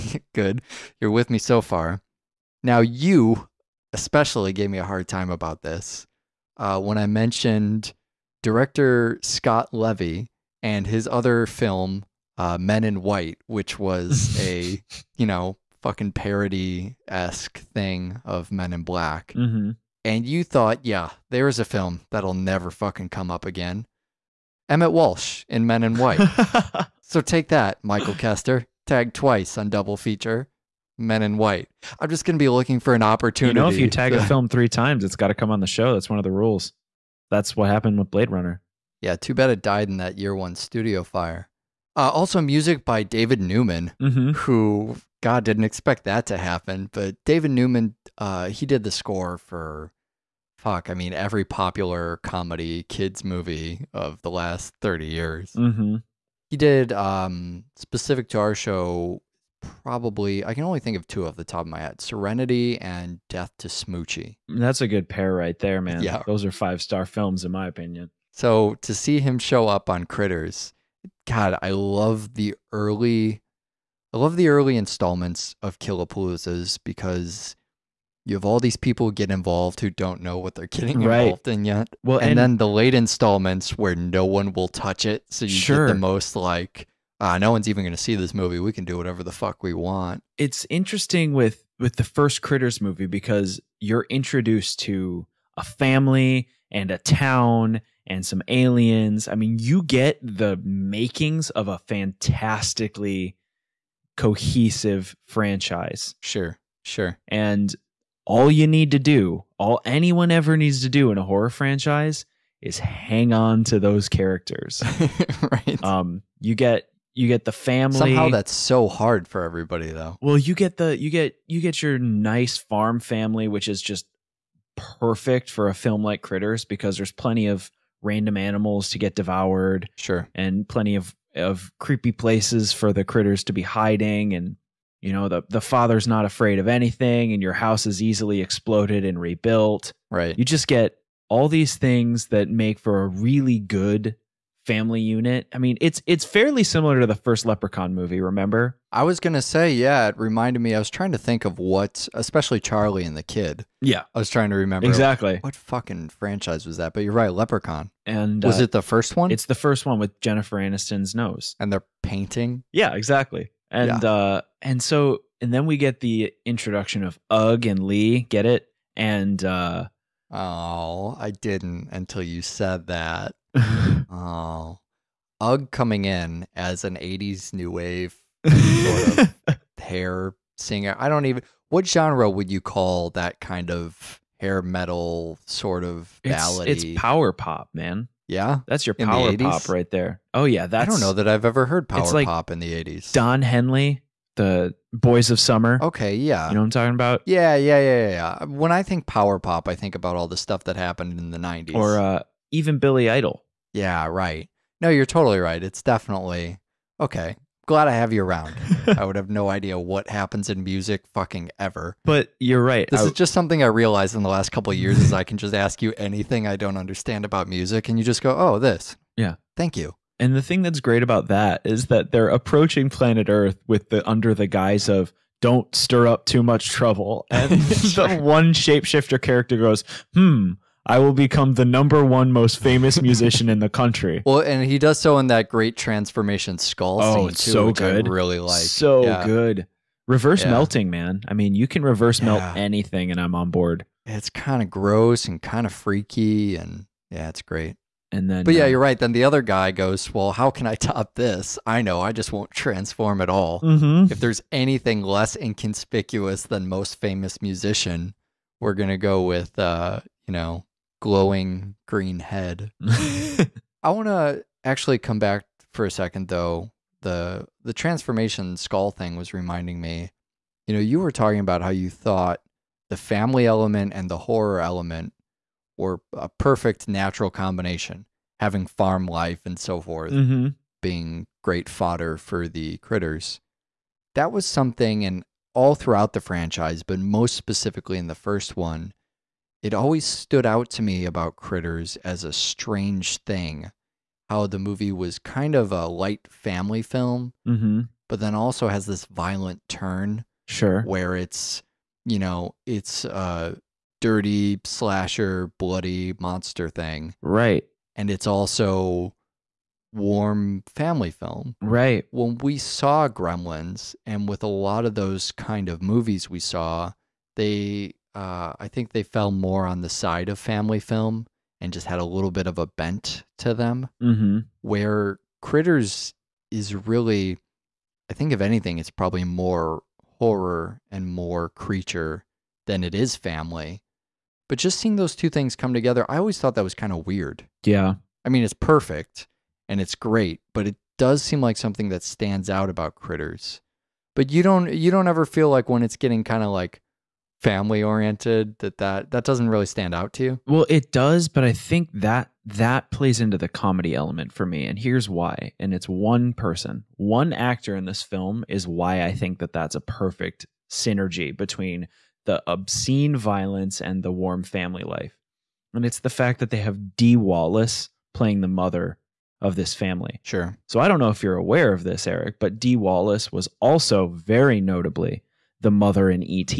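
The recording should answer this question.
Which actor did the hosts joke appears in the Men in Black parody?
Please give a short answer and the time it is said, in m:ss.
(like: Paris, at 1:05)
Emmet Walsh, at 0:24.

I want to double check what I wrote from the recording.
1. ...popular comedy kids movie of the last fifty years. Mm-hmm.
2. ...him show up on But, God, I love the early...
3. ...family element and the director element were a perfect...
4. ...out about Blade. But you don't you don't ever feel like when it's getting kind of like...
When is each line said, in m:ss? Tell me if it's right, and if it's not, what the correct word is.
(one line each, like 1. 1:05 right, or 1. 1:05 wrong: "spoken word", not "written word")
1. 0:51 wrong: "thirty", not "fifty"
2. 1:09 wrong: "Critters", not "But"
3. 4:32 wrong: "horror", not "director"
4. 5:42 wrong: "Critters", not "Blade".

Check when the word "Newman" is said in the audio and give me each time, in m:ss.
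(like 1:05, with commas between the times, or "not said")
0:43, 0:47.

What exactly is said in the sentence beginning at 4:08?
And then But yeah, um, you're right.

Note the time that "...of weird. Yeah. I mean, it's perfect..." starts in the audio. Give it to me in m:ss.
5:36.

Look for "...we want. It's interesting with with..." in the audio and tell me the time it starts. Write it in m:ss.
1:29.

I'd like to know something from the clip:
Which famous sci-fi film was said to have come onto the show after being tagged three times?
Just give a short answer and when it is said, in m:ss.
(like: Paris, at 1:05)
Blade Runner, at 0:38.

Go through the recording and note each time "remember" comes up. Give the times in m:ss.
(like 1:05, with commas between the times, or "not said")
2:28, 2:34.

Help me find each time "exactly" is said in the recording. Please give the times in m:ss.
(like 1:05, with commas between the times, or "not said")
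2:34, 2:42.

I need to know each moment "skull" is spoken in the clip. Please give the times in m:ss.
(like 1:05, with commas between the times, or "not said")
3:56, 4:28.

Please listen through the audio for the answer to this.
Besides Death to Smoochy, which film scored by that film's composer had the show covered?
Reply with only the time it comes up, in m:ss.
1:02.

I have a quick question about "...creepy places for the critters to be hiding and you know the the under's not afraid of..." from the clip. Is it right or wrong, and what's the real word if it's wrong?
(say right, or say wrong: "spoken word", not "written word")
wrong: "father", not "under".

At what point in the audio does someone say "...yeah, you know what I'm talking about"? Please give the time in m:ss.
3:16.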